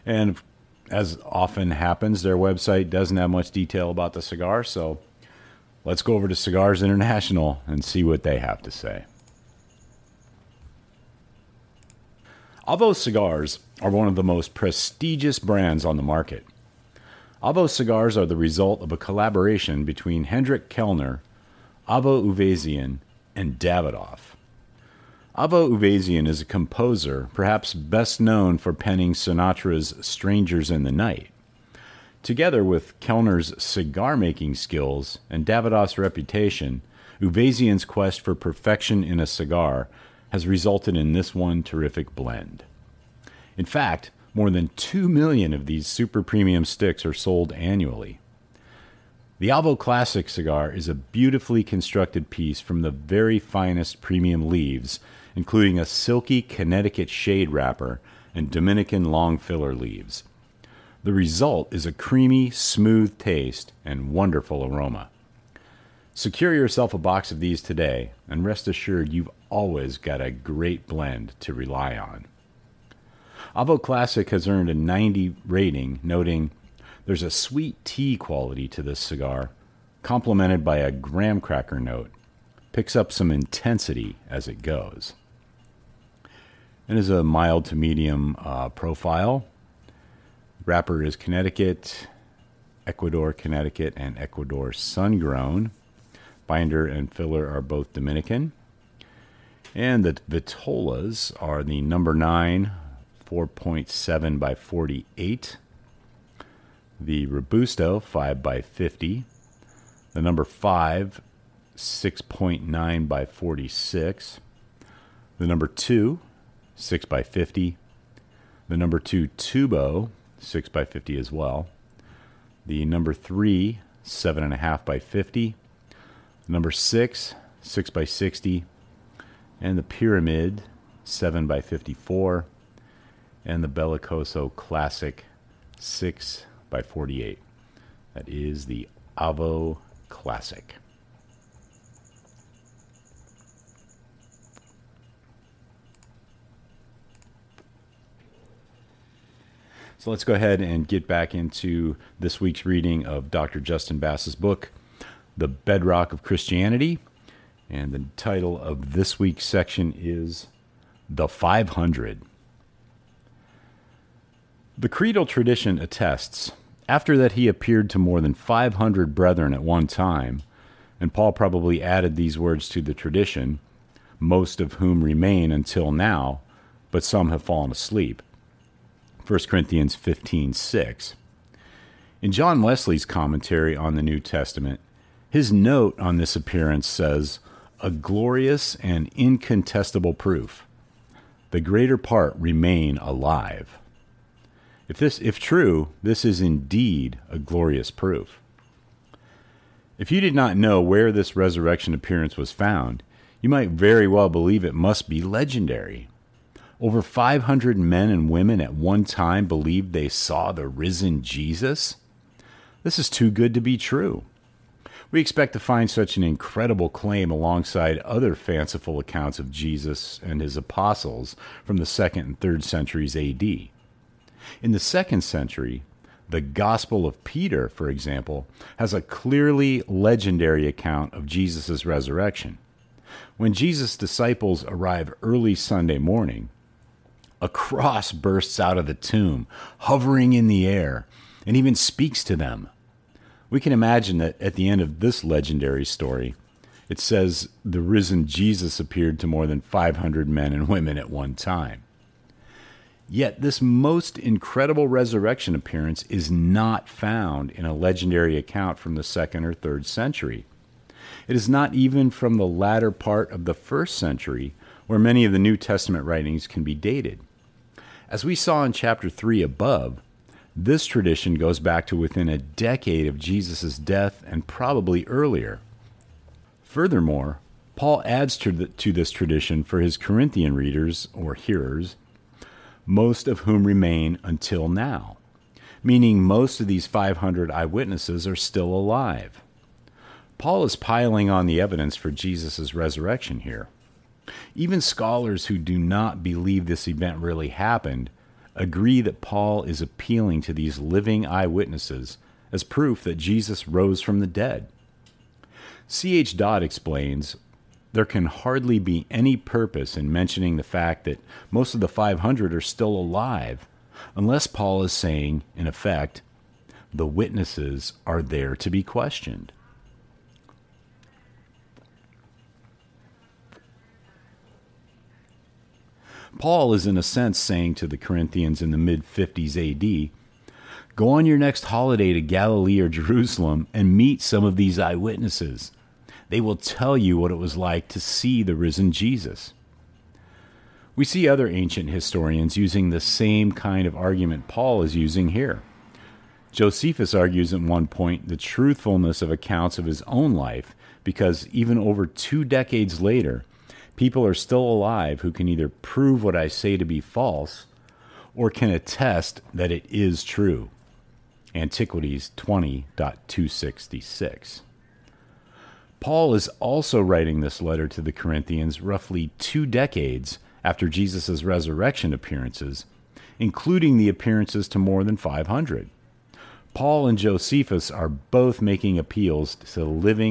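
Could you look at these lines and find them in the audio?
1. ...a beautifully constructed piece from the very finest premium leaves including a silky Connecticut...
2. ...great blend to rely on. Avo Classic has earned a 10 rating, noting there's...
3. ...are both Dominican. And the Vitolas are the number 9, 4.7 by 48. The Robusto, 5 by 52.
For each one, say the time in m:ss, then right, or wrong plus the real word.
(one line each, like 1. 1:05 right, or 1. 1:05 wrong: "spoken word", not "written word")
1. 0:50 right
2. 1:10 wrong: "90", not "10"
3. 1:37 wrong: "50", not "52".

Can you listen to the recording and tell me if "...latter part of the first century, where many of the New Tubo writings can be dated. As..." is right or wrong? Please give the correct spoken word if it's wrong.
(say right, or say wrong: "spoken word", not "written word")
wrong: "Testament", not "Tubo".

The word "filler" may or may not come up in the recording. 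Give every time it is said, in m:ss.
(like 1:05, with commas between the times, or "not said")
0:59, 1:37.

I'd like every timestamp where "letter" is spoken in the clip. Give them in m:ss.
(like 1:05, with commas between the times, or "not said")
6:07.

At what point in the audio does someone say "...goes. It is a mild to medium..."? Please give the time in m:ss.
1:24.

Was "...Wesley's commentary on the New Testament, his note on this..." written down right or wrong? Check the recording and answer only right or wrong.
right.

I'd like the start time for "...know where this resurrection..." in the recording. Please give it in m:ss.
3:20.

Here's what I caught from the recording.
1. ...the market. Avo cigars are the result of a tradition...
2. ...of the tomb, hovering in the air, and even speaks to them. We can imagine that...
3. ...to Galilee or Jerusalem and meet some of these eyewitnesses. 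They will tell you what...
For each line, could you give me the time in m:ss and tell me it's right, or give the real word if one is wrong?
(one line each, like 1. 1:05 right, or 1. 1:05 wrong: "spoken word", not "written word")
1. 0:15 wrong: "collaboration", not "tradition"
2. 3:58 right
3. 5:32 right.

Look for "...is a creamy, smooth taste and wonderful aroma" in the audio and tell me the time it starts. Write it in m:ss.
1:01.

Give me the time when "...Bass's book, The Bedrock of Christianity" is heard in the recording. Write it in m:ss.
2:33.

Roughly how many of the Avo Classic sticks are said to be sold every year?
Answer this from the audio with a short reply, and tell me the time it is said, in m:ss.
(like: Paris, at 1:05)
2 million, at 0:44.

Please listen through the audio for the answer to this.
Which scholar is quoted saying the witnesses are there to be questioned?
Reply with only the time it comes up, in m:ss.
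5:05.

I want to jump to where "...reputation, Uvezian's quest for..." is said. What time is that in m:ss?
0:35.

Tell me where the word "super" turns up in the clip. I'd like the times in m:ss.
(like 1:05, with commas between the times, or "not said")
0:45.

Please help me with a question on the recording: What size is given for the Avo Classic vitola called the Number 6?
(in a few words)
6 by 60.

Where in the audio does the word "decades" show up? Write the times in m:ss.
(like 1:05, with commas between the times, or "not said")
4:32, 5:52, 6:09.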